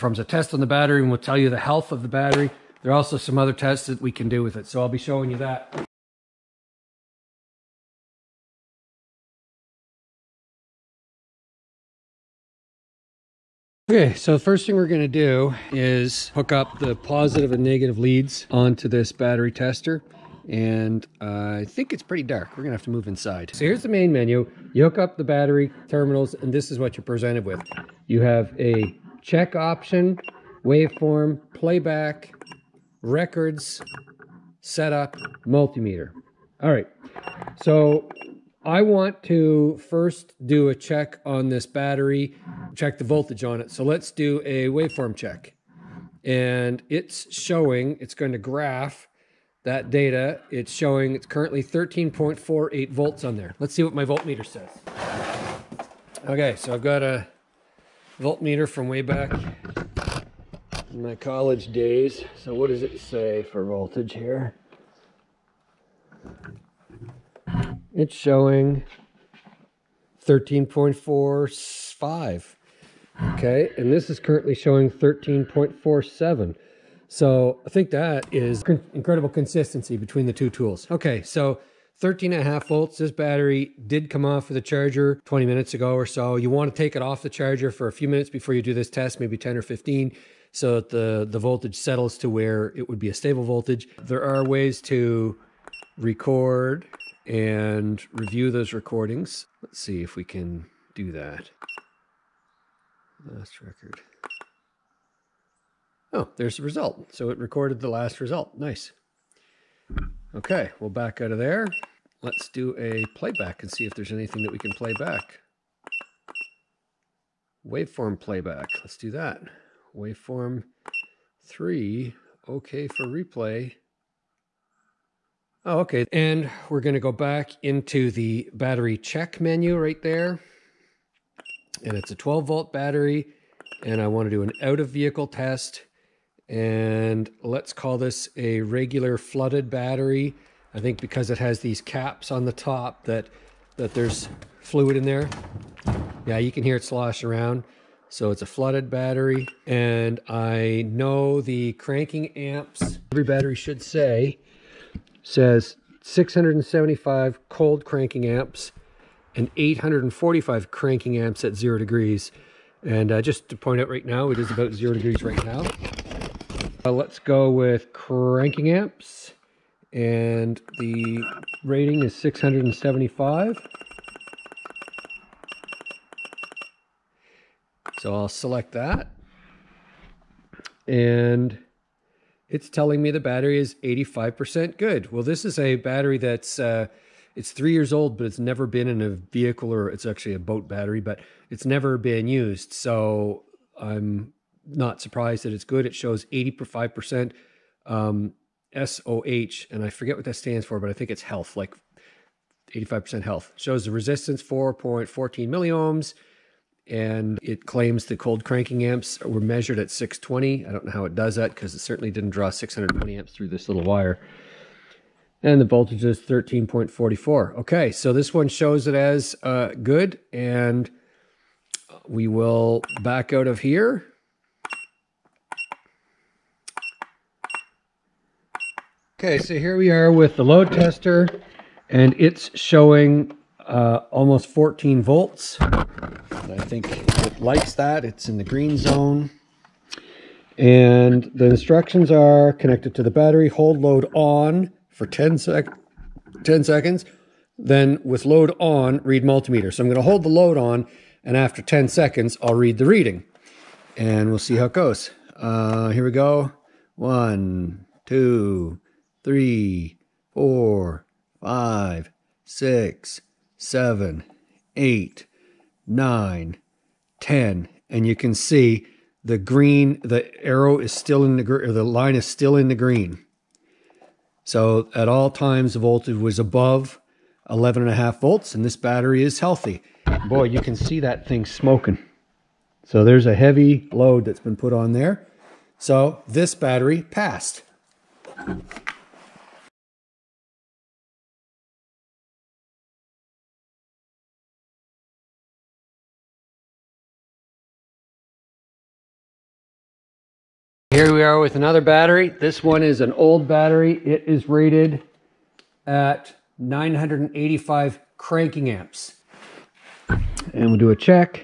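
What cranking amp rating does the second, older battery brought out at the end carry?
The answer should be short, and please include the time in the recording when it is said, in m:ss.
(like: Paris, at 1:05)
985, at 5:06.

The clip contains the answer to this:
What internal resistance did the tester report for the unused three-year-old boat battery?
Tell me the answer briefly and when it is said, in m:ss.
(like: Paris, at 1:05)
4.14 milliohms, at 3:24.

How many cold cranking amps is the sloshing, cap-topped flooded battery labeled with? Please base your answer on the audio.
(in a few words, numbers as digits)
675.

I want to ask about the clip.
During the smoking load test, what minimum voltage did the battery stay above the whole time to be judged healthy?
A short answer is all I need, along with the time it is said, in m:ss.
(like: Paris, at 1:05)
11.5 volts, at 4:37.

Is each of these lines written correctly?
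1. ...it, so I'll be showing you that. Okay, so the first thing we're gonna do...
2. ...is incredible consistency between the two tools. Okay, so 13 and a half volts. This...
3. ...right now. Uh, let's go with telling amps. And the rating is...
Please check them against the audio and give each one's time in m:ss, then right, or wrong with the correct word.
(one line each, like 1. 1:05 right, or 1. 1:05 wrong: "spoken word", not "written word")
1. 0:04 right
2. 1:18 right
3. 2:45 wrong: "cranking", not "telling".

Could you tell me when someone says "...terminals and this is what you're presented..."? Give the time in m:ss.
0:25.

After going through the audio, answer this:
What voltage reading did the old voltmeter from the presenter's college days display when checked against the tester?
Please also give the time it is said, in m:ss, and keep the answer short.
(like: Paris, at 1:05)
13.45, at 1:10.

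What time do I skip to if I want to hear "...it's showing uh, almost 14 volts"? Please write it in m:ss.
3:52.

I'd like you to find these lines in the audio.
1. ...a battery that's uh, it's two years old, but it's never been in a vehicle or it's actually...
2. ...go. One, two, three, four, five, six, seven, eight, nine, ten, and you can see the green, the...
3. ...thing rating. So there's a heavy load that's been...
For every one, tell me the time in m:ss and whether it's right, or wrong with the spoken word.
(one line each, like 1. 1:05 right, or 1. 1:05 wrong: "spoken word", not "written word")
1. 3:05 wrong: "three", not "two"
2. 4:16 right
3. 4:41 wrong: "smoking", not "rating".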